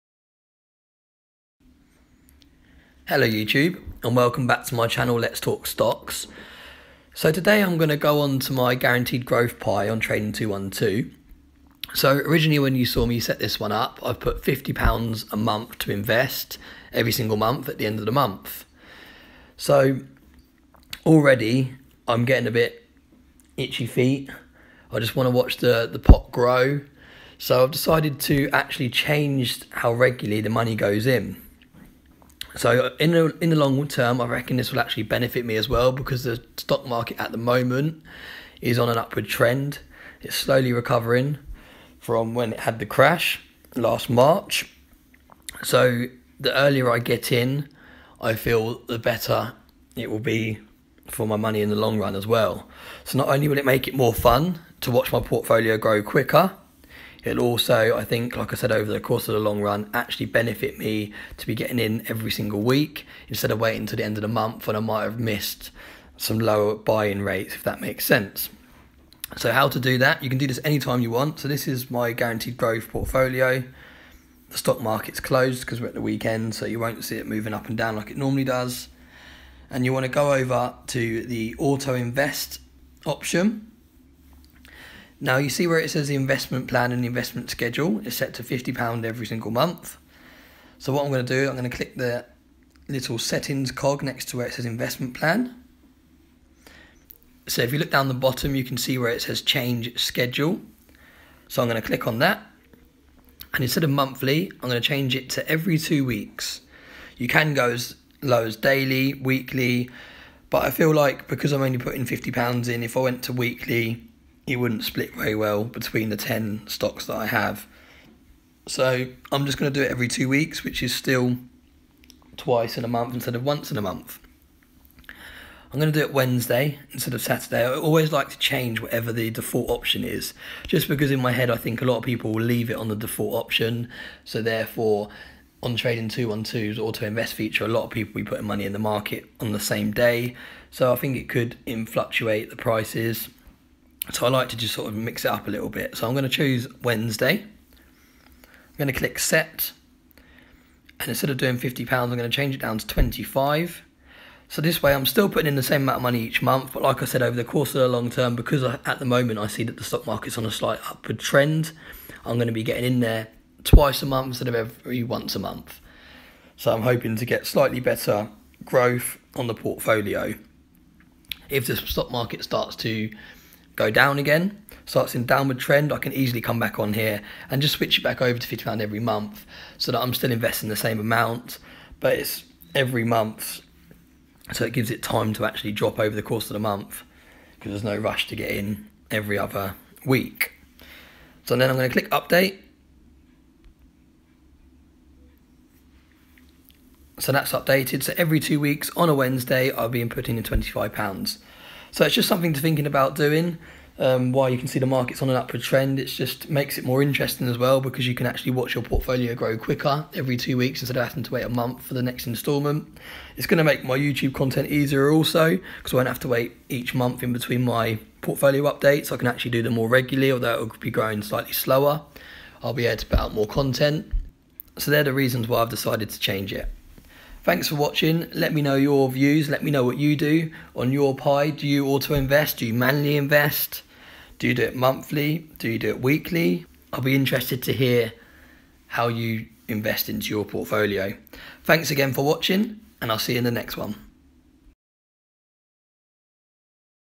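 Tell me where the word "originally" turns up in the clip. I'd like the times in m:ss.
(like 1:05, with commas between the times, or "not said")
0:12.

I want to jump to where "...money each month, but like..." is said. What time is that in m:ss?
2:36.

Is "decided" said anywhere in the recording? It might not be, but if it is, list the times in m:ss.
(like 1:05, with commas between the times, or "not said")
0:27, 3:45.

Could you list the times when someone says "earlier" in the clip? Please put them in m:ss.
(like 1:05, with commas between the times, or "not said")
0:46.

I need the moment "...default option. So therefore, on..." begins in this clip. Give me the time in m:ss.
2:12.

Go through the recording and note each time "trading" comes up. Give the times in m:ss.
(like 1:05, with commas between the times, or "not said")
0:09, 2:15.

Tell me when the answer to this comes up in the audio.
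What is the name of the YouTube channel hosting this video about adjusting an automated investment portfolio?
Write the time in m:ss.
0:05.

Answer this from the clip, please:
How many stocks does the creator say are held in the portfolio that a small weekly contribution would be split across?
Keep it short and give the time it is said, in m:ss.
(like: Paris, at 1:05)
10, at 1:56.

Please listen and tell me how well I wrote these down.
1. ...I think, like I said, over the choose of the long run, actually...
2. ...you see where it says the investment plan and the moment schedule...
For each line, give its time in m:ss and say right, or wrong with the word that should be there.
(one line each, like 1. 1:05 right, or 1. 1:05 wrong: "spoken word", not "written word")
1. 0:57 wrong: "course", not "choose"
2. 1:25 wrong: "investment", not "moment".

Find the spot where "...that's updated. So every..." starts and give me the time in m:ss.
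3:17.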